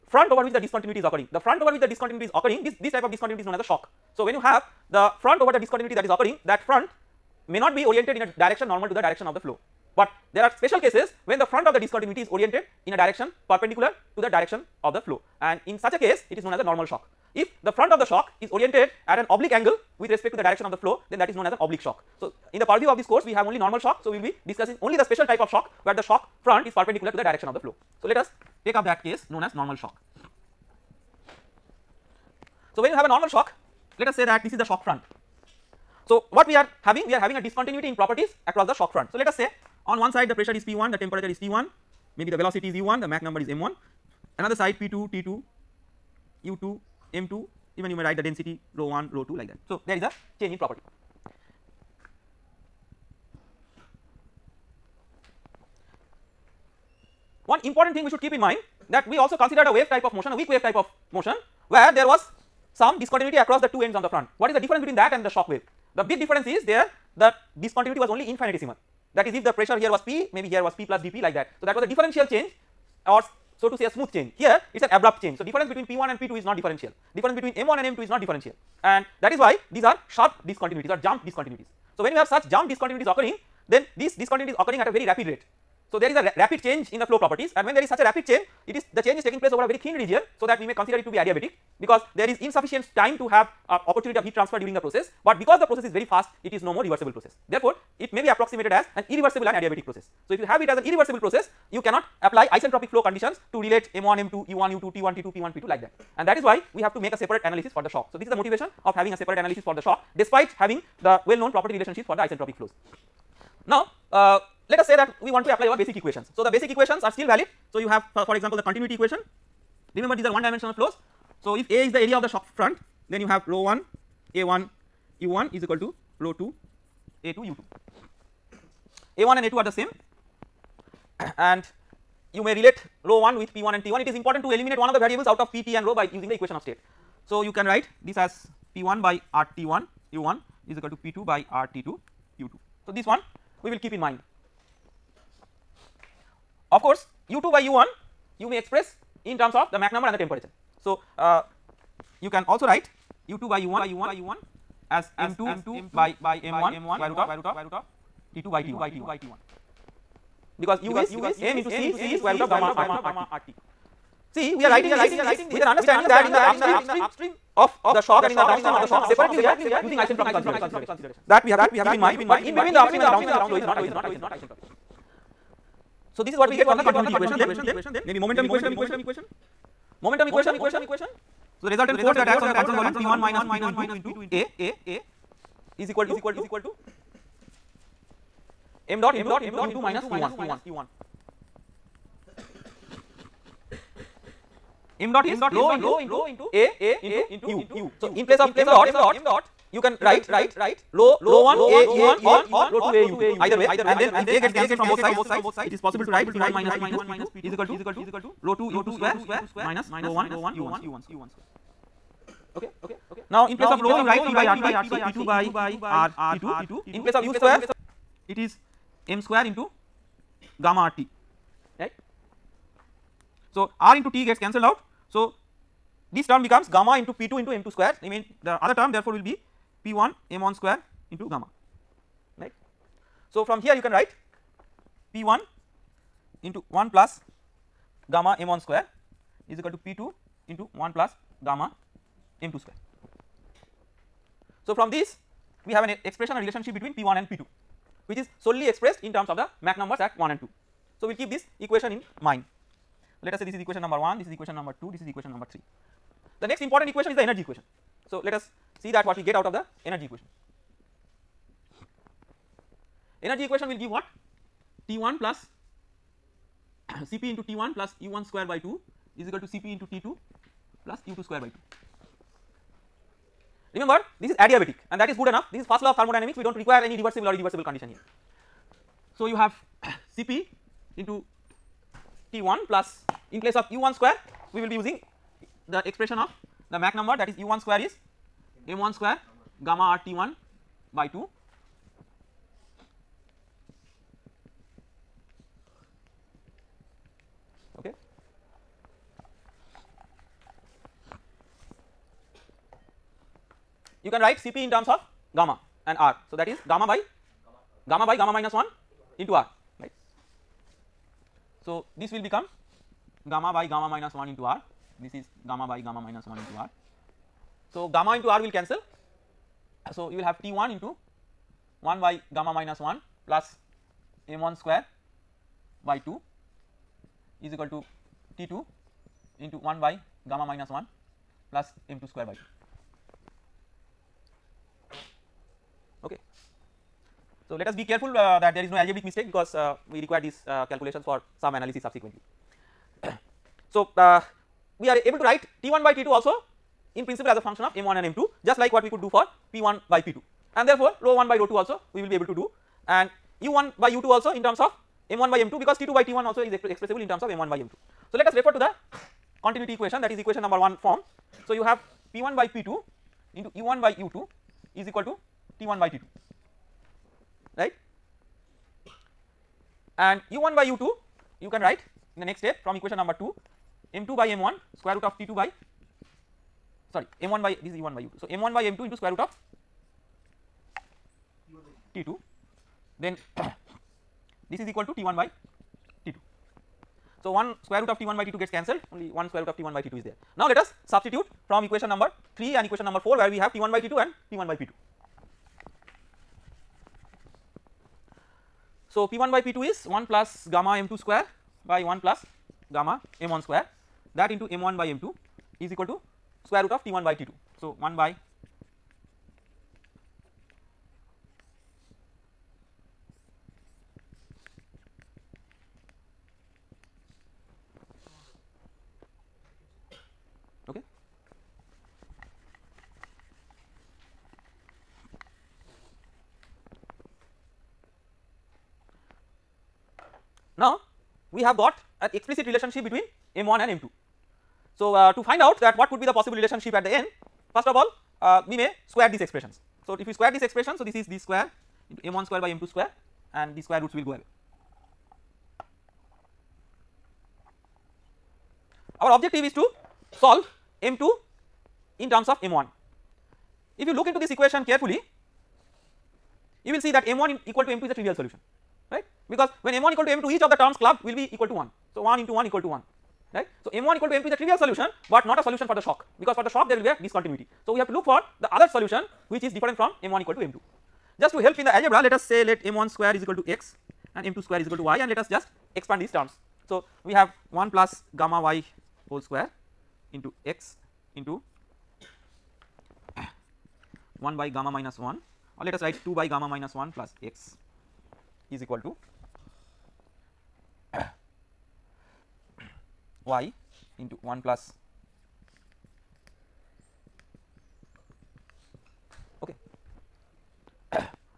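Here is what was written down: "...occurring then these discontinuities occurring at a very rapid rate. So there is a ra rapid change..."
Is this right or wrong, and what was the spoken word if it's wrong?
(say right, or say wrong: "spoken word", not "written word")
right.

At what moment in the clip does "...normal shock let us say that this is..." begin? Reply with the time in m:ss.
0:33.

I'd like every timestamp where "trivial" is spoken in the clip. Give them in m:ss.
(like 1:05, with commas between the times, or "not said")
7:37, 7:44.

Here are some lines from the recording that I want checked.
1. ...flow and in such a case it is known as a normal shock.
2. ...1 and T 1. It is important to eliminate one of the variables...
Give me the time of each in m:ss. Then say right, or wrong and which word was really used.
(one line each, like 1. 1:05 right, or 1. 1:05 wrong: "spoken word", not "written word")
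1. 0:15 right
2. 2:13 right.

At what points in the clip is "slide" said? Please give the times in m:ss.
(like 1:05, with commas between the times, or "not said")
not said.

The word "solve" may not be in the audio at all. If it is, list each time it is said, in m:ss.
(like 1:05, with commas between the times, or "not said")
7:30.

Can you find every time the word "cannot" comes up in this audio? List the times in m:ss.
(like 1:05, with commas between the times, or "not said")
1:41.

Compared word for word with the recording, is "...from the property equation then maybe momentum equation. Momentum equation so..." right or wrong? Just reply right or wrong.
wrong.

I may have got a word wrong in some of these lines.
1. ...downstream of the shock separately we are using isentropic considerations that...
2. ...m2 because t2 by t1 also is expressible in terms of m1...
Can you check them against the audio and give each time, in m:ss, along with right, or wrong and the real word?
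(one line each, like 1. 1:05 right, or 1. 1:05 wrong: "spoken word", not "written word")
1. 2:48 right
2. 5:55 right.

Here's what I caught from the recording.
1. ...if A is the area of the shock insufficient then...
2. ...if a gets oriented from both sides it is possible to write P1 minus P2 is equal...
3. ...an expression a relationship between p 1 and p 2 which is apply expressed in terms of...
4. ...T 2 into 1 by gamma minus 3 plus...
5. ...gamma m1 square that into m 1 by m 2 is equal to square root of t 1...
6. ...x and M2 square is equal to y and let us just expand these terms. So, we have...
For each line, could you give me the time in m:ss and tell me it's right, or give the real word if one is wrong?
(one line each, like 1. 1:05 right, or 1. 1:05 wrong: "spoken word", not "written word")
1. 2:01 wrong: "front", not "insufficient"
2. 3:24 wrong: "cancelled", not "oriented"
3. 4:05 wrong: "solely", not "apply"
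4. 5:28 wrong: "1", not "3"
5. 6:42 right
6. 7:53 right.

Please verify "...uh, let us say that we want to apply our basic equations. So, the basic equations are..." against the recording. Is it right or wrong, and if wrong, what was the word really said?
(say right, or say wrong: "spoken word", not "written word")
right.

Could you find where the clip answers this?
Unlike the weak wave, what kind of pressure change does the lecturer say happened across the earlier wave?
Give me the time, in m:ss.
1:11.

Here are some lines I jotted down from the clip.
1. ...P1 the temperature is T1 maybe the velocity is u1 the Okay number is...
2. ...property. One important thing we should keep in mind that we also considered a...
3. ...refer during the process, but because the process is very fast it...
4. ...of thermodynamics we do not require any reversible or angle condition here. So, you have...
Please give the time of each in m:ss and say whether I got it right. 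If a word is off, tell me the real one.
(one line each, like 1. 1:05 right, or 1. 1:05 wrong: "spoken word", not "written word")
1. 0:40 wrong: "Mach", not "Okay"
2. 0:50 right
3. 1:34 wrong: "transfer", not "refer"
4. 4:35 wrong: "irreversible", not "angle".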